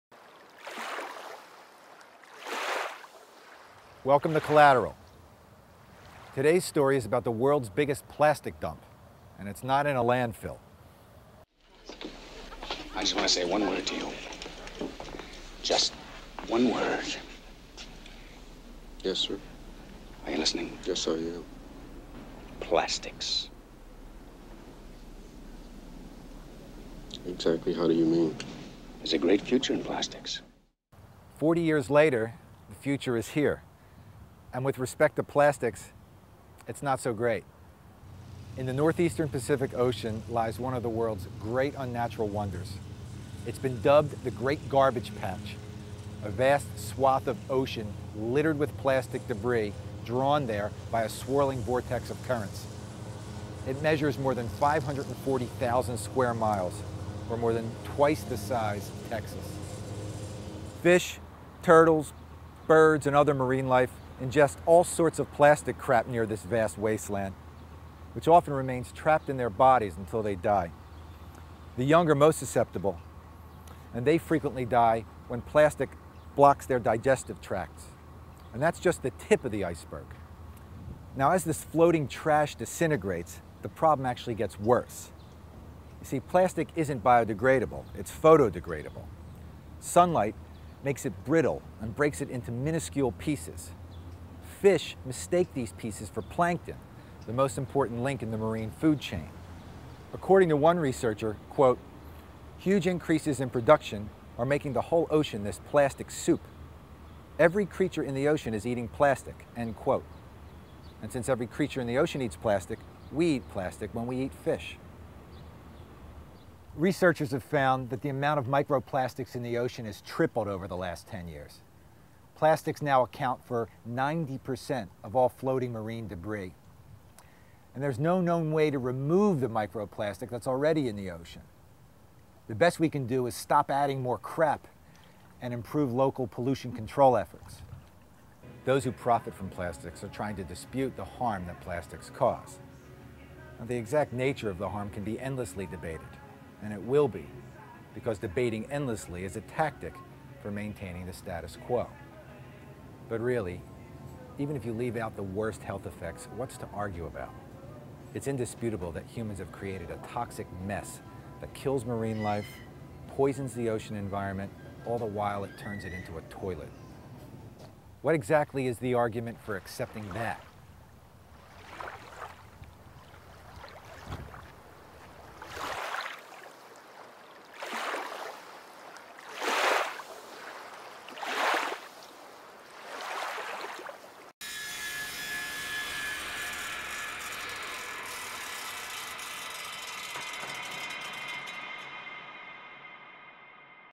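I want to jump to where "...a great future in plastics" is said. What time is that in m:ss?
0:29.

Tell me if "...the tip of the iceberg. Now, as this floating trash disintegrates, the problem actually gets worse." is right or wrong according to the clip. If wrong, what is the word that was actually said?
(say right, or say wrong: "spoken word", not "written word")
right.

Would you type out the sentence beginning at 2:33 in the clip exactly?
But really, even if you leave out the worst health effects, what's to argue about?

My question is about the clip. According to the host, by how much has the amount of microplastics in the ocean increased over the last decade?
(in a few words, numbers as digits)
tripled.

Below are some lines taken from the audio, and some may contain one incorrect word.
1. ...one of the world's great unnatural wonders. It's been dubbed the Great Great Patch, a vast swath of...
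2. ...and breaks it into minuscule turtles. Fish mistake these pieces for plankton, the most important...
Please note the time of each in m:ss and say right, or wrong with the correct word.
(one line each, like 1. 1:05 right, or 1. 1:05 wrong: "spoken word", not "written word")
1. 0:40 wrong: "Garbage", not "Great"
2. 1:31 wrong: "pieces", not "turtles".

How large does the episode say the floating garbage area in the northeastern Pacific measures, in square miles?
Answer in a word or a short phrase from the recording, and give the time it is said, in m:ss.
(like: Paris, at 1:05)
540,000 square miles, at 0:54.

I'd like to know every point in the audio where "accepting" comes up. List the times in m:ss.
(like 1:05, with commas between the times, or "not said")
2:49.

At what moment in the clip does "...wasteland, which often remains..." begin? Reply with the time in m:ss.
1:06.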